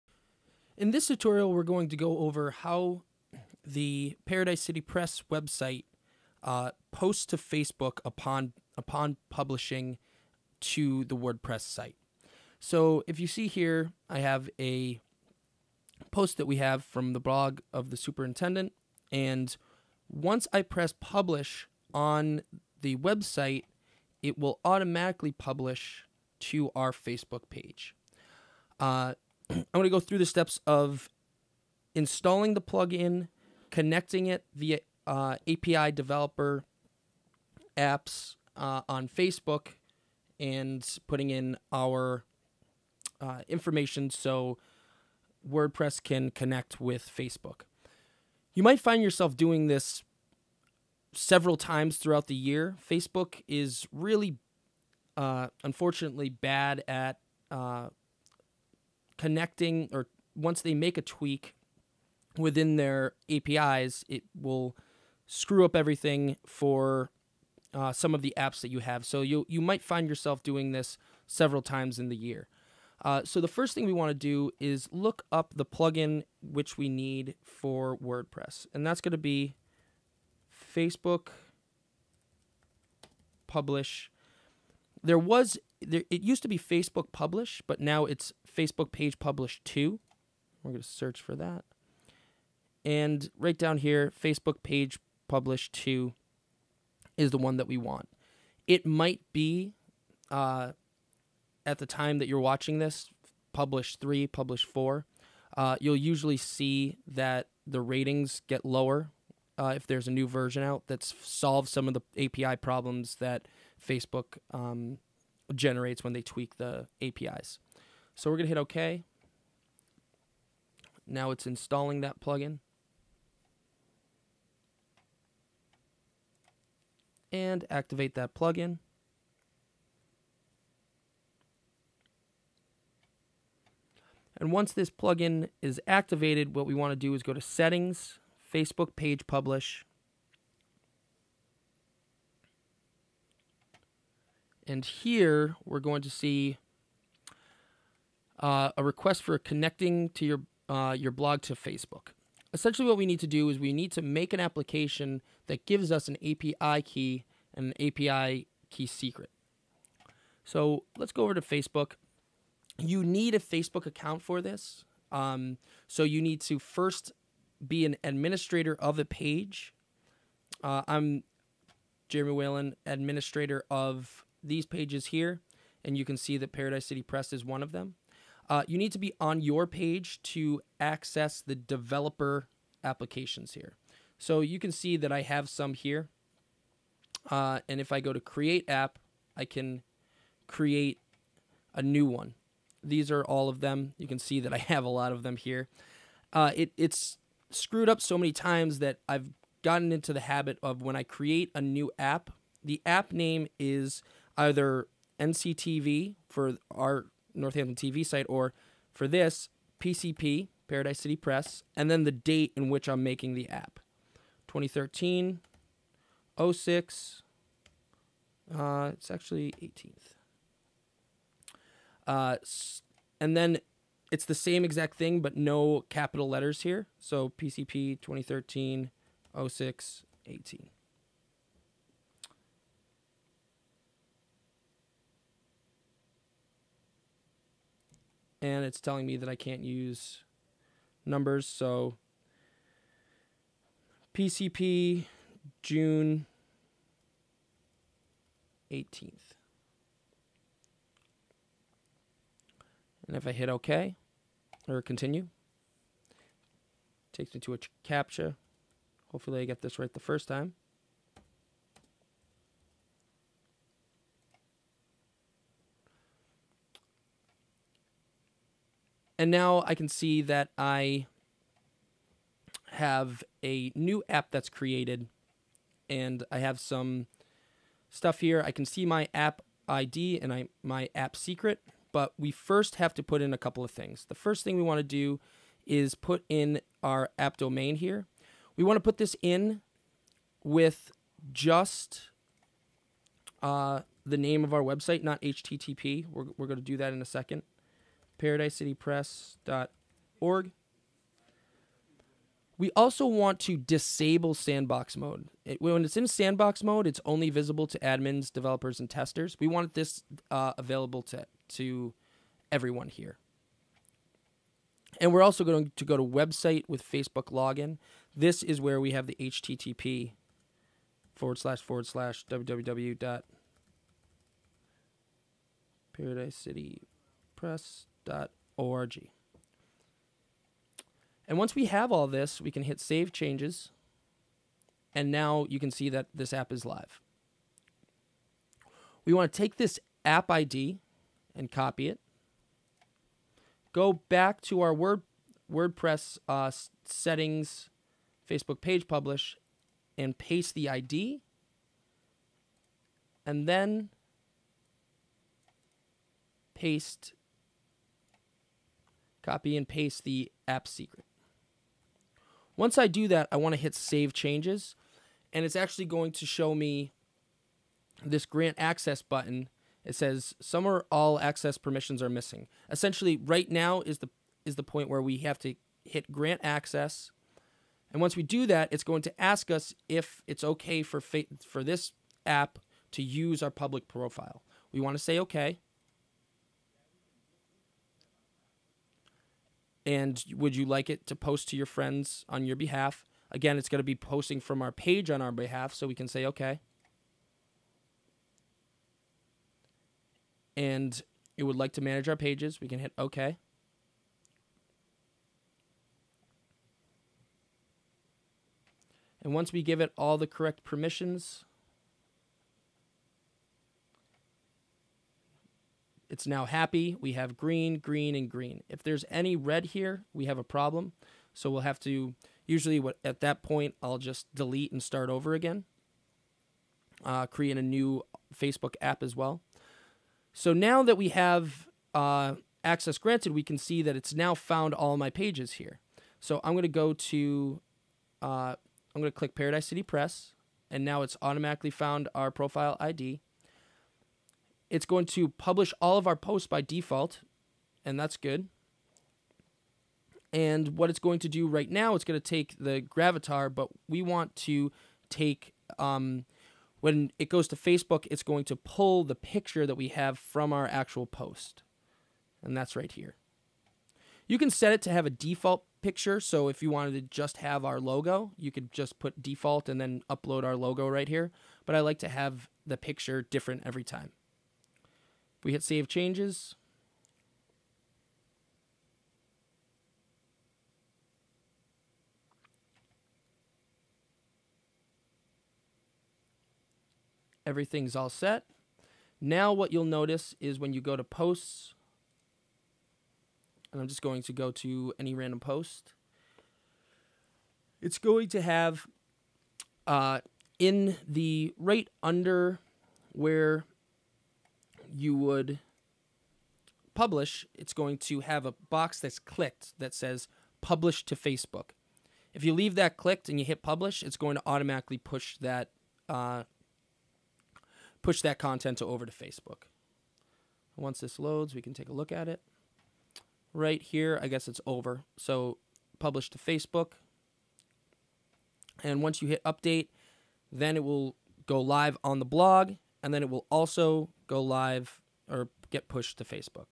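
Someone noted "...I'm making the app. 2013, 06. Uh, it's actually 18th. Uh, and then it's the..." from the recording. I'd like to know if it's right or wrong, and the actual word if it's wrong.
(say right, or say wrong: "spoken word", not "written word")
right.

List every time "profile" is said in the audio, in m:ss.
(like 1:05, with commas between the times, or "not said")
6:23, 7:22.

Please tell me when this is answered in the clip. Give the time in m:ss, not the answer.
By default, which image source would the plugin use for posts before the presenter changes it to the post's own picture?
7:32.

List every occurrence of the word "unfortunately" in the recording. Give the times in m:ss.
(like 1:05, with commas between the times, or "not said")
0:55.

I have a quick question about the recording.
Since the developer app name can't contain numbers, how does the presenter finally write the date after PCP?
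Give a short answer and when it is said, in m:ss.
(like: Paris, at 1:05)
June 18th, at 4:05.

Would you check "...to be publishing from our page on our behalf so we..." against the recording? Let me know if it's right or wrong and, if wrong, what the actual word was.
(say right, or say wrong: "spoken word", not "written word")
wrong: "posting", not "publishing".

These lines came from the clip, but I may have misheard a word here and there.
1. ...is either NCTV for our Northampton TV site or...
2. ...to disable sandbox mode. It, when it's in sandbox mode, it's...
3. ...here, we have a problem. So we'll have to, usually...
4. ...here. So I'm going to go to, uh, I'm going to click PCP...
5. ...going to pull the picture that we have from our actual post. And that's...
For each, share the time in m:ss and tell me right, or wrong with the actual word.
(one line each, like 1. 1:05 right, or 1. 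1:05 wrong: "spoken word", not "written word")
1. 3:23 right
2. 5:03 right
3. 6:59 right
4. 7:15 wrong: "Paradise", not "PCP"
5. 7:38 right.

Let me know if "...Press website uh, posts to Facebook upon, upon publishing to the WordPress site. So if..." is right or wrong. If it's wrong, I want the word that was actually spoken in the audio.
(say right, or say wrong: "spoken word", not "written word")
right.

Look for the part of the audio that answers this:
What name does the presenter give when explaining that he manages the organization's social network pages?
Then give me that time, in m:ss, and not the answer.
2:52.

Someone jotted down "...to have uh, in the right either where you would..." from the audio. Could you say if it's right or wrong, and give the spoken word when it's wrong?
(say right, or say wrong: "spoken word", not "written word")
wrong: "under", not "either".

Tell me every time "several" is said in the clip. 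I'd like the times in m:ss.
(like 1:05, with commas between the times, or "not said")
0:51, 1:11.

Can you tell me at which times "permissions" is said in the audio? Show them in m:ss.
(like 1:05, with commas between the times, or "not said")
6:11, 6:50.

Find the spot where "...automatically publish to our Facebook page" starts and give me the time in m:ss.
0:24.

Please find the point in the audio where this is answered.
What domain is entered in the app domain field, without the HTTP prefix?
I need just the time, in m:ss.
4:58.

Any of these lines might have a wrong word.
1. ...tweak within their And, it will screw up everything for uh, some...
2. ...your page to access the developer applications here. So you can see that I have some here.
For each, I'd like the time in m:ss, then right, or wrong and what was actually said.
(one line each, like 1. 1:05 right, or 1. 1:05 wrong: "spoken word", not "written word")
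1. 1:01 wrong: "APIs", not "And"
2. 2:59 right.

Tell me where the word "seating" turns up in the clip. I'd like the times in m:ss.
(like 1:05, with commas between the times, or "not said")
not said.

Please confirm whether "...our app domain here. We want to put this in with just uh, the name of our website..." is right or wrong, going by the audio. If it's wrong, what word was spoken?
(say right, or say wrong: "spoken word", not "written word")
right.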